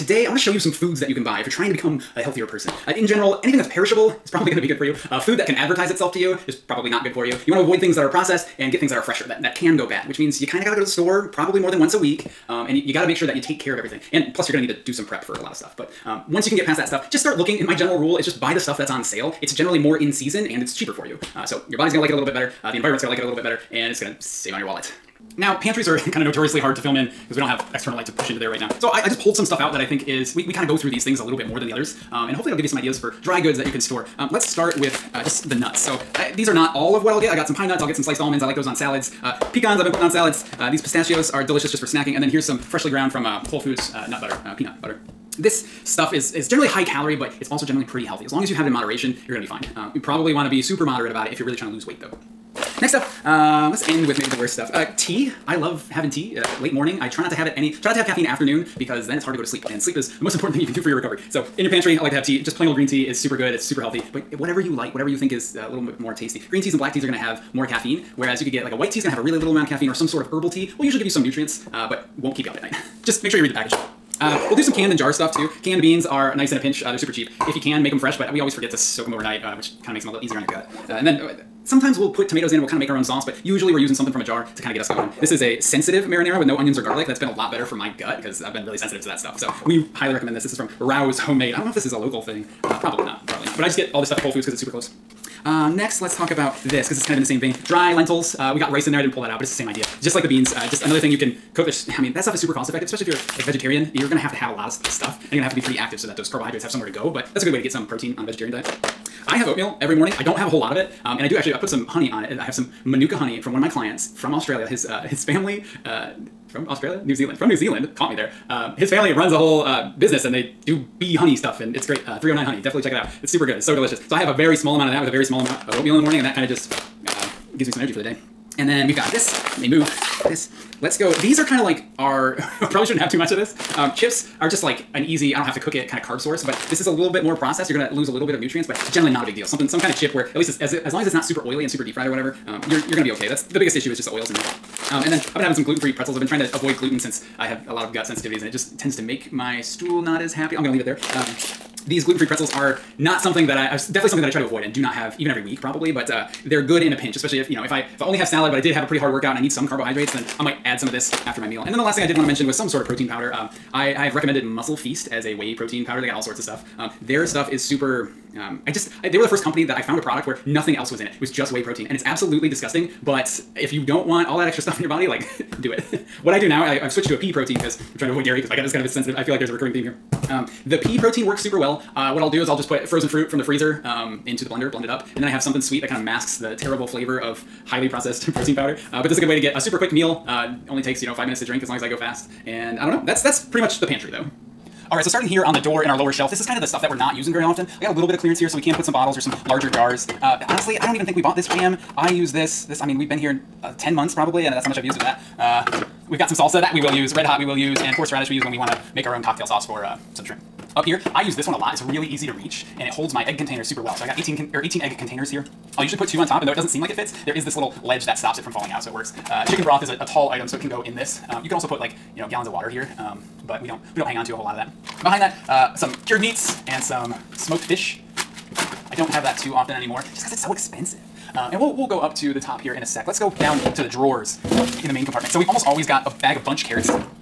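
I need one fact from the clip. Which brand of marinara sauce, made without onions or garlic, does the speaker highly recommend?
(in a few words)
Rao's Homemade.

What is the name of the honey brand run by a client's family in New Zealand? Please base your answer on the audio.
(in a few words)
309 honey.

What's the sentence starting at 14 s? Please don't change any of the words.
And plus, you're going to need to do some prep for a lot of stuff.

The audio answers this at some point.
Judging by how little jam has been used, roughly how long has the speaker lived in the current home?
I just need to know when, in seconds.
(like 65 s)
203 s.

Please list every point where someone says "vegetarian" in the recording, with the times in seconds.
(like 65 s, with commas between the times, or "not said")
103 s, 108 s.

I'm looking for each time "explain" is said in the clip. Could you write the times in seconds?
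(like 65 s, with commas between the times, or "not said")
not said.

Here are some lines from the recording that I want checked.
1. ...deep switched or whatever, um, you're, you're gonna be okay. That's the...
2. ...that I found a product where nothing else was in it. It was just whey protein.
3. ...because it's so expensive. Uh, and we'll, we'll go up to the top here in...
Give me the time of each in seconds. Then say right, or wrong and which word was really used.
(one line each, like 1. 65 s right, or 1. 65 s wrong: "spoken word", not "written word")
1. 141 s wrong: "fried", not "switched"
2. 169 s right
3. 230 s right.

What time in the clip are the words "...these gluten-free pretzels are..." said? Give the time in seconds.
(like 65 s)
151 s.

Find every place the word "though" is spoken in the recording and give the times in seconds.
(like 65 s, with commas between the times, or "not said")
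52 s, 194 s, 216 s.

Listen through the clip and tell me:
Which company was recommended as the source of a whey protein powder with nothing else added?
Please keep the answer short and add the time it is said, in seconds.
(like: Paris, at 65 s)
Muscle Feast, at 164 s.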